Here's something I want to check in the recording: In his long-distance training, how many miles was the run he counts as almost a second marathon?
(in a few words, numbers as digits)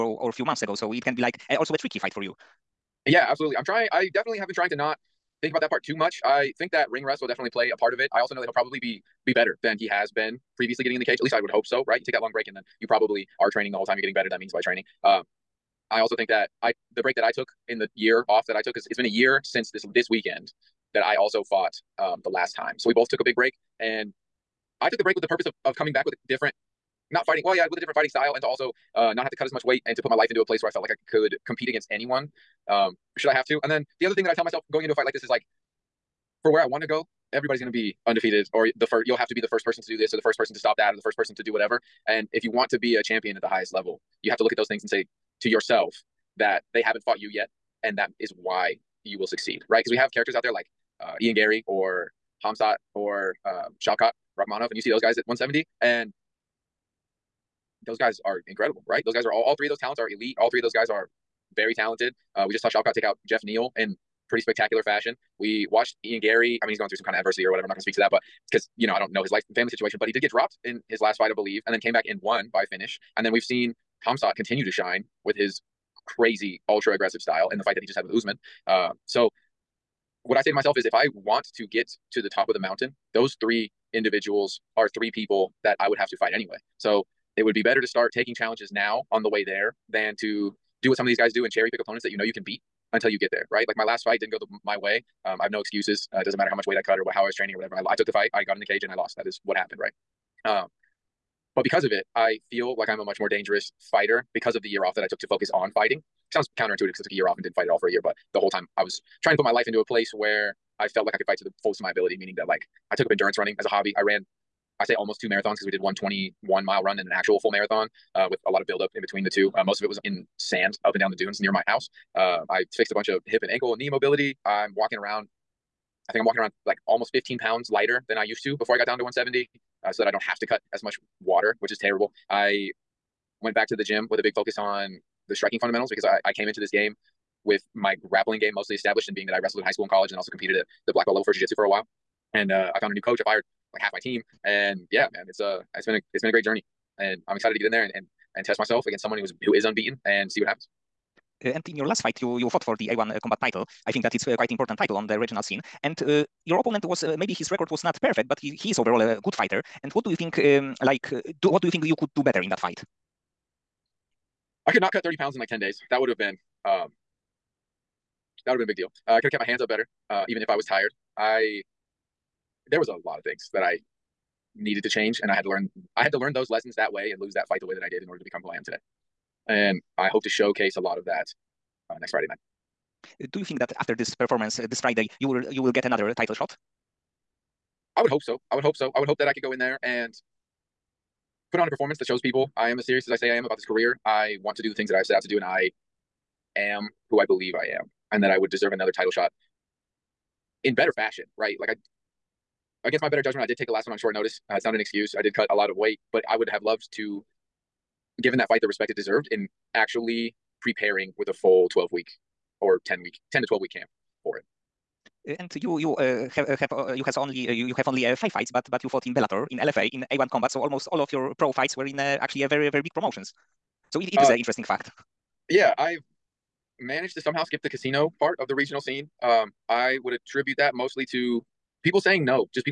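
21.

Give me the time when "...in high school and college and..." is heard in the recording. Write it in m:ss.
2:19.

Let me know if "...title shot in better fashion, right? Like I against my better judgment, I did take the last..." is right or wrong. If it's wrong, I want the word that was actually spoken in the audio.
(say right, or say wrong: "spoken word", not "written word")
right.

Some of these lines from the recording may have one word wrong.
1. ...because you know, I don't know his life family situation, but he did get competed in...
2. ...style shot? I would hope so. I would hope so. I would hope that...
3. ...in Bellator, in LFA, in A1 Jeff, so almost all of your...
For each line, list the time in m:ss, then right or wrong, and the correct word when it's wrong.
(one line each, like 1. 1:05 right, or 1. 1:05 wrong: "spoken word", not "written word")
1. 1:08 wrong: "dropped", not "competed"
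2. 3:06 wrong: "title", not "style"
3. 3:39 wrong: "Combat", not "Jeff".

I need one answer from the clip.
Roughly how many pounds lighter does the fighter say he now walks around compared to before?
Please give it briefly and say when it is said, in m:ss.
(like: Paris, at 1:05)
15, at 2:07.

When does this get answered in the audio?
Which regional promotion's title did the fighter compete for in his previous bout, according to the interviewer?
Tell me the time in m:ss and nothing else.
2:32.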